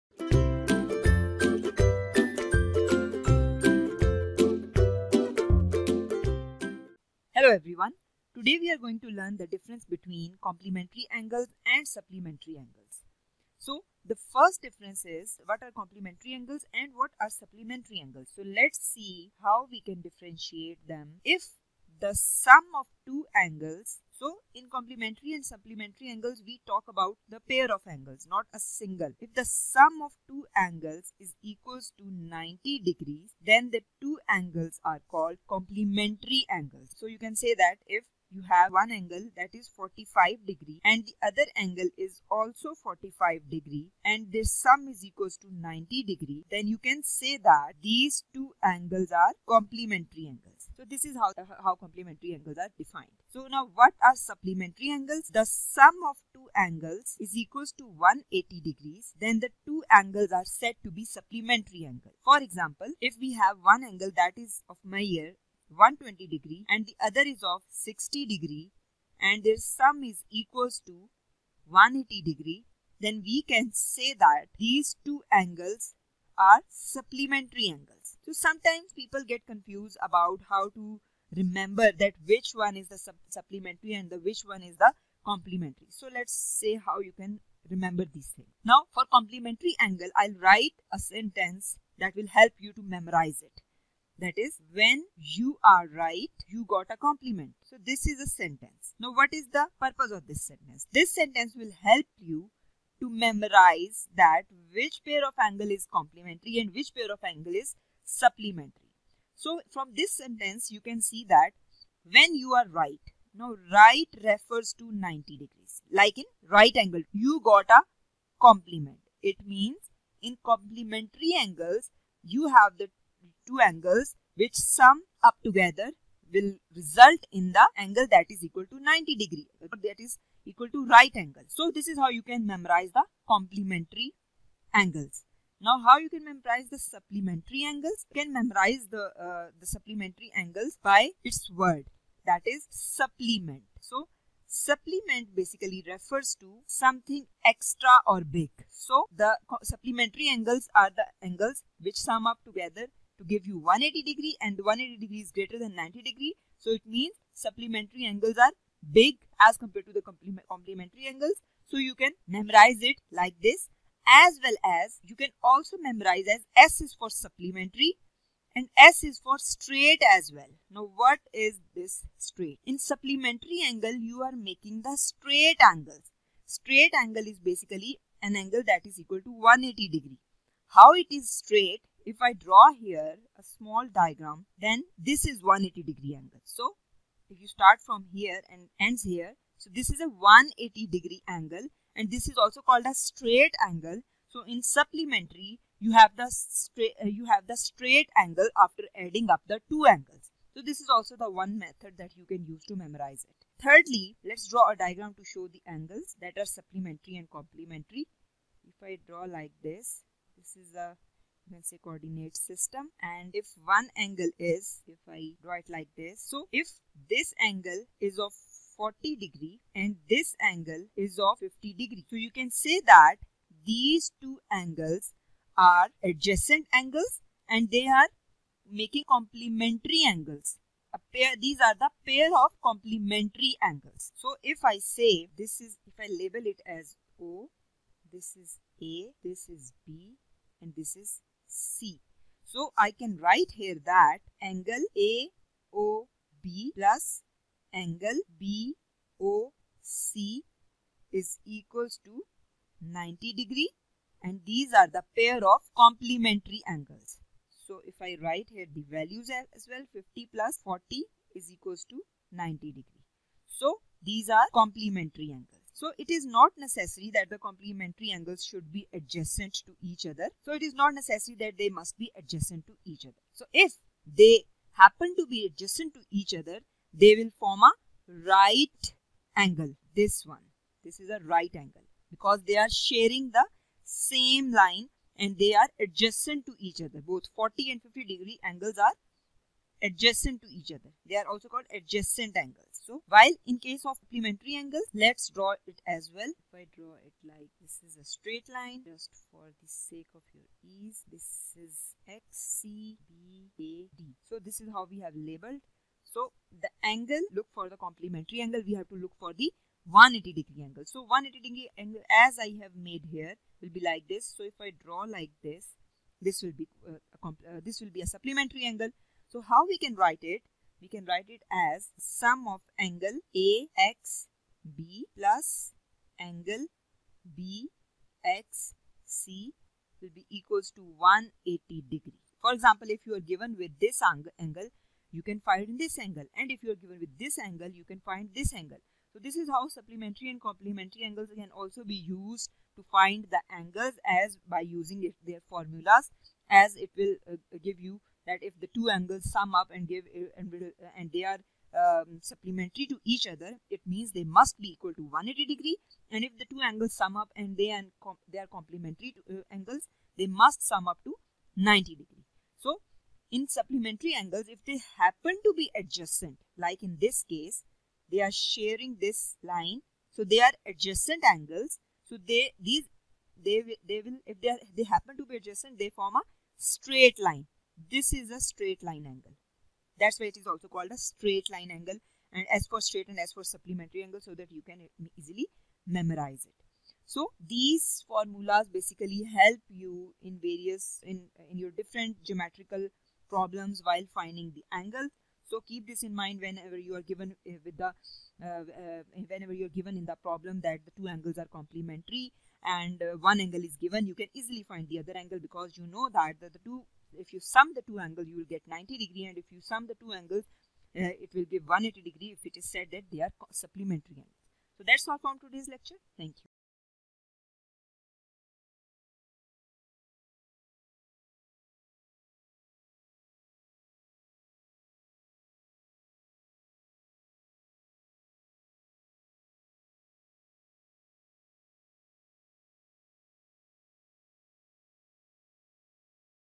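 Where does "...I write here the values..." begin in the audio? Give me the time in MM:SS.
04:18.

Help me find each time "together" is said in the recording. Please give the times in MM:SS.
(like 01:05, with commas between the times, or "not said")
02:05, 02:32.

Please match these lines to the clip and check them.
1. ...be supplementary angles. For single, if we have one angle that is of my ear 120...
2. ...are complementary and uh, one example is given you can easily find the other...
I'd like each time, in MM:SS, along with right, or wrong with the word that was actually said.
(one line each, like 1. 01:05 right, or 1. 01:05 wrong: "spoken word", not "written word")
1. 01:00 wrong: "example", not "single"
2. 06:41 wrong: "angle", not "example".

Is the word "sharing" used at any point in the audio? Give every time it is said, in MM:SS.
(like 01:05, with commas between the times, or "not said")
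04:42, 06:08.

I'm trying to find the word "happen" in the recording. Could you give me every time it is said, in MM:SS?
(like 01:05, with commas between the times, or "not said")
04:34, 06:04, 06:14.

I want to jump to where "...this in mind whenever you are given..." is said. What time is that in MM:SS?
06:35.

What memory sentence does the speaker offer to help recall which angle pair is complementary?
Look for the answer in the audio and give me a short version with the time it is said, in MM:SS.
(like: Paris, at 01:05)
When you are right, you got a compliment, at 01:34.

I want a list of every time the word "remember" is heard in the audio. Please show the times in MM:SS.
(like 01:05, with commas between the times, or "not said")
01:21, 01:27.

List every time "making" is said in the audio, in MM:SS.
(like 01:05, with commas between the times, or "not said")
02:54, 03:48.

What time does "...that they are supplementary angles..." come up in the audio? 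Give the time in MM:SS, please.
06:52.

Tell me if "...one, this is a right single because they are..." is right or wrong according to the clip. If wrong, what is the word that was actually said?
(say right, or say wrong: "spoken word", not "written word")
wrong: "angle", not "single".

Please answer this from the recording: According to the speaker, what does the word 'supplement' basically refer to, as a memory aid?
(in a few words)
something extra or big.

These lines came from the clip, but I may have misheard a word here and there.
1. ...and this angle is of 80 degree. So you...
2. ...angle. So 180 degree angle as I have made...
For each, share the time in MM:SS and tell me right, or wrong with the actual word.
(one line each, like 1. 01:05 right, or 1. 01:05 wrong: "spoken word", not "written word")
1. 03:39 wrong: "50", not "80"
2. 05:10 right.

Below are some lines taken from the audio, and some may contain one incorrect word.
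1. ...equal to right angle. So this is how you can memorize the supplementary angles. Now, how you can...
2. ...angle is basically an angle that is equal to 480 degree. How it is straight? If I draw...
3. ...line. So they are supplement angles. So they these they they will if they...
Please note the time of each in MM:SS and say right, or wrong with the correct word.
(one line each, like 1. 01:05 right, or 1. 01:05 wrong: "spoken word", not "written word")
1. 02:10 wrong: "complementary", not "supplementary"
2. 02:56 wrong: "180", not "480"
3. 06:09 wrong: "adjacent", not "supplement".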